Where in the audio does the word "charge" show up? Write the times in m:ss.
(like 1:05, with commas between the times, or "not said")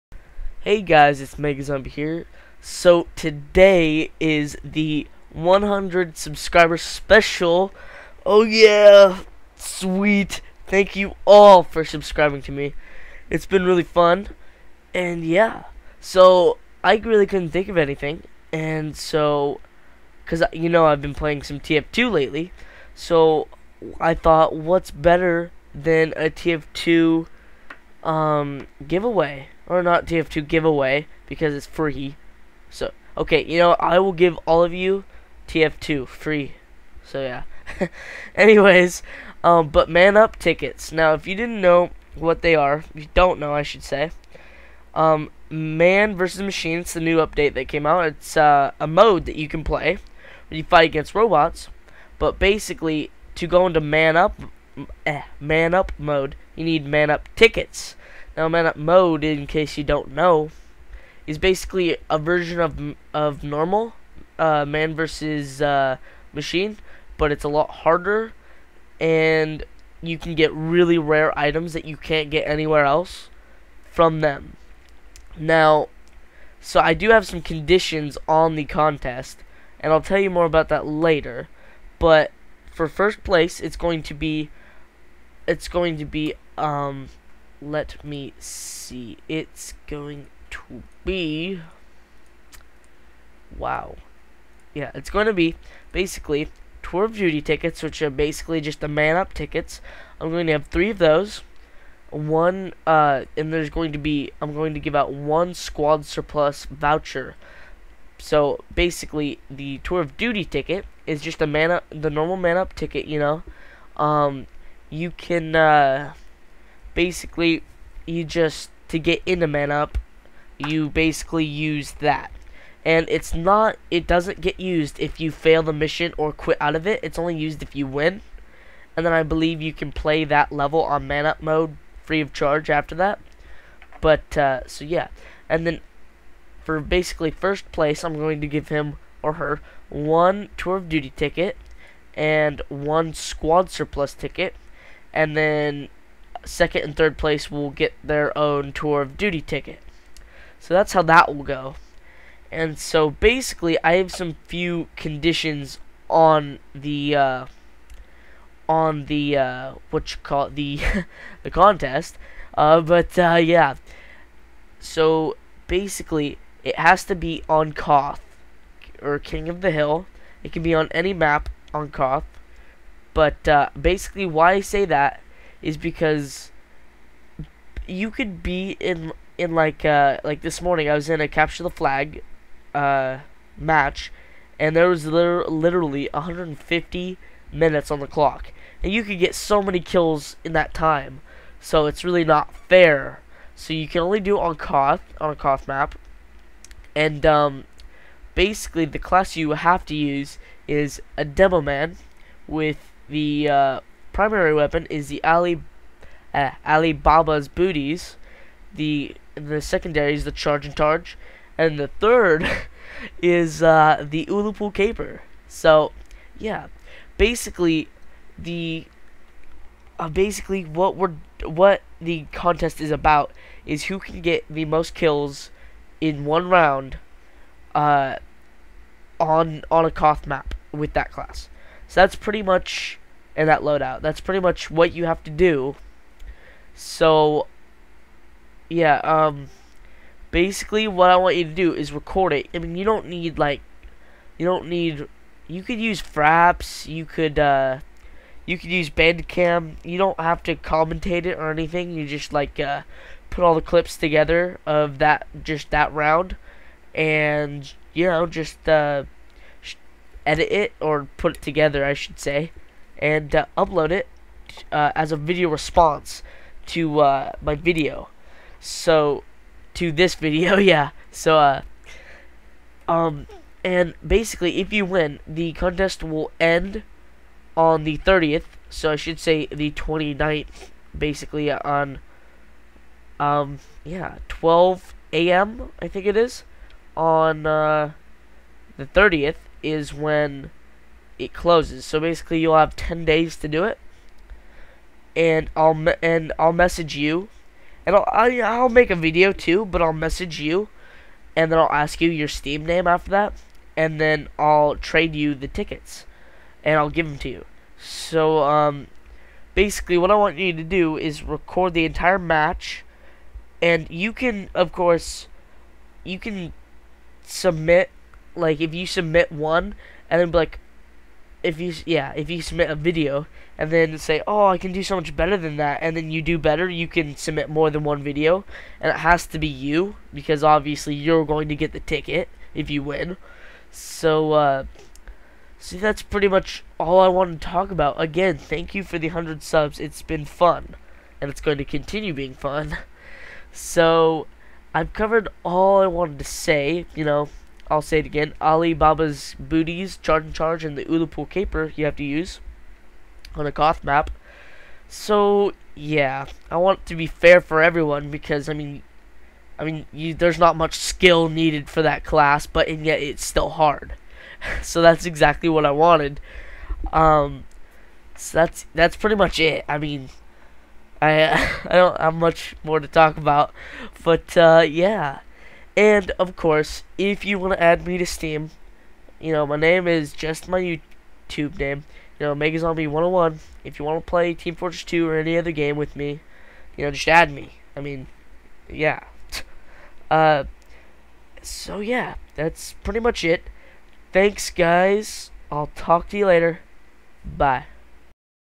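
2:12, 3:30, 5:50.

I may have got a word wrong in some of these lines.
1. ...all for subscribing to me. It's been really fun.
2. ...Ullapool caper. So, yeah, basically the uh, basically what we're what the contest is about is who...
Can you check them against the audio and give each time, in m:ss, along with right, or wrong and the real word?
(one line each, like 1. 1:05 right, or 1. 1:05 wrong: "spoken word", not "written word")
1. 0:11 right
2. 3:34 right.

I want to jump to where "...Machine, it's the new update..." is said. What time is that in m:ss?
0:46.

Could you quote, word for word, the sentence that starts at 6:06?
Um, so that's that's pretty much it.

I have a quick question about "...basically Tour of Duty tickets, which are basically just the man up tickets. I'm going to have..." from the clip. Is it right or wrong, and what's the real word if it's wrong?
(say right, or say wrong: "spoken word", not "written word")
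right.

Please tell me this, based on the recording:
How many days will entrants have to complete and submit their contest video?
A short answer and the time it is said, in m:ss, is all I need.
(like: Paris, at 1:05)
10, at 4:52.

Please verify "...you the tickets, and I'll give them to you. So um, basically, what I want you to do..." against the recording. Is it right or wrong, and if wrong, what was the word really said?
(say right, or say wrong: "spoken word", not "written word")
right.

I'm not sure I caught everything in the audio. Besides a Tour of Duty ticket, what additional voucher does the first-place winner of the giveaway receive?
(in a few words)
Squad surplus voucher.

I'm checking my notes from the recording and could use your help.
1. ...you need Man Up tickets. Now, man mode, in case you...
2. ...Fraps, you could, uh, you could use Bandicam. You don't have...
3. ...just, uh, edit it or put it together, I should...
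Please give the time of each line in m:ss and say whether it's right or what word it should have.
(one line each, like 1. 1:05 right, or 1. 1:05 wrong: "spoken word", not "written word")
1. 0:56 right
2. 4:06 right
3. 4:18 right.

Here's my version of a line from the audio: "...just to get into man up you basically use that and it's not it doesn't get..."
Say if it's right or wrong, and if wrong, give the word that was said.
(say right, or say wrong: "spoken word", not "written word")
right.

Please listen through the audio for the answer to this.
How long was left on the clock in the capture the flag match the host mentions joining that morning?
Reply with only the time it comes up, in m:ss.
3:06.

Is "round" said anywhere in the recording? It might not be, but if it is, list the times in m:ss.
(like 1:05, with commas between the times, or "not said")
3:46, 4:15.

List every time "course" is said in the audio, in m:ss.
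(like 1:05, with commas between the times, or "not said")
5:14, 6:16.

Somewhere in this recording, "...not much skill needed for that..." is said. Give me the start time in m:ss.
6:00.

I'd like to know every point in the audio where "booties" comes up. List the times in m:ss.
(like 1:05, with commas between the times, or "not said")
3:27, 5:49.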